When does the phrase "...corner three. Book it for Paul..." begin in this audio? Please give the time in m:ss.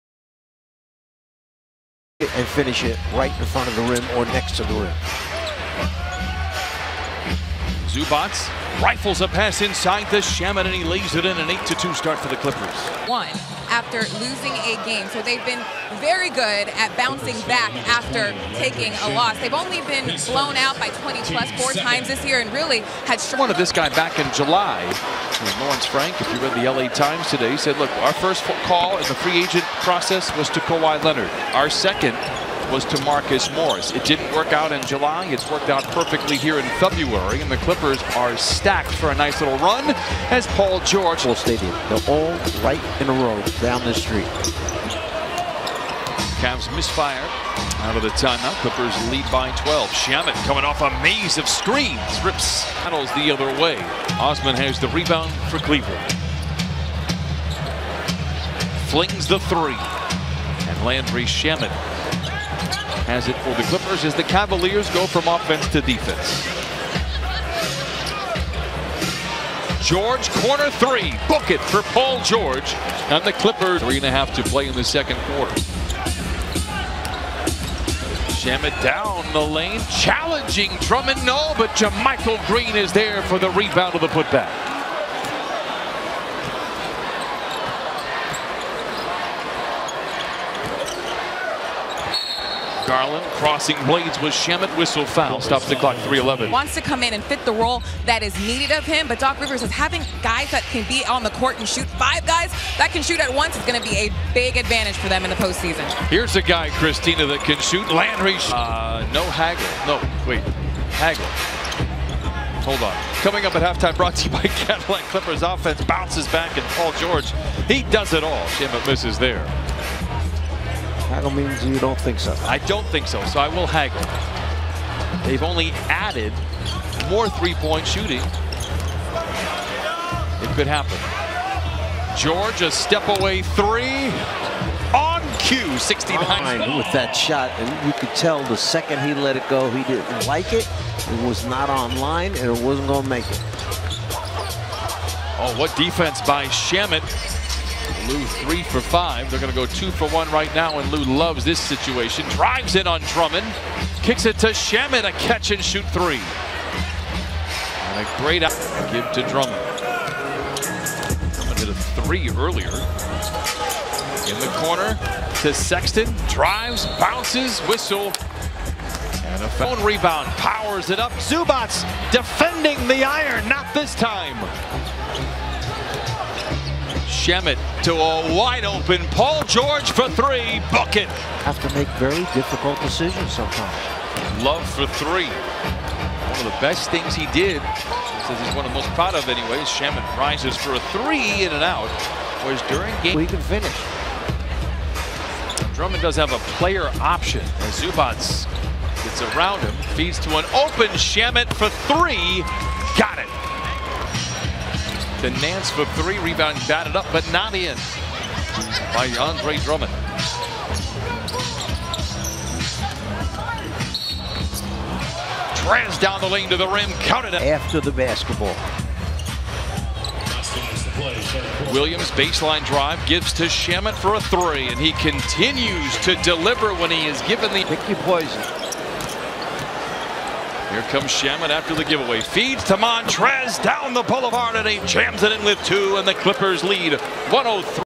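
1:10.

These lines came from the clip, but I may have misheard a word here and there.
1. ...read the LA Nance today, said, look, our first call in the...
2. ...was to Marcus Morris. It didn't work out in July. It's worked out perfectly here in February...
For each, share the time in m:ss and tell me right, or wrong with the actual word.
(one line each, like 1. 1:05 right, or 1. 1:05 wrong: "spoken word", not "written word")
1. 0:26 wrong: "Times", not "Nance"
2. 0:32 right.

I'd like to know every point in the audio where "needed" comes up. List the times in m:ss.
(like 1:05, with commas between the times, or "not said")
1:38.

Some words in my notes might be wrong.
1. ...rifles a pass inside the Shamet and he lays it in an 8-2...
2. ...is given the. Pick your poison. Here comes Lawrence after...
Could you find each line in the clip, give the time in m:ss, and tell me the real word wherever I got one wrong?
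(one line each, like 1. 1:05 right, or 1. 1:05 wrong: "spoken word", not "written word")
1. 0:08 right
2. 3:47 wrong: "Shamet", not "Lawrence".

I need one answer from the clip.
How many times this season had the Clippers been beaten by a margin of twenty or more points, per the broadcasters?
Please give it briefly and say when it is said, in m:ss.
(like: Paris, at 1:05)
4, at 0:21.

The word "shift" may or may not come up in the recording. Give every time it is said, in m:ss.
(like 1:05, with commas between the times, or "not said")
not said.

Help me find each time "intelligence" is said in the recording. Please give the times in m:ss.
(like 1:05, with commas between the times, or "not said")
not said.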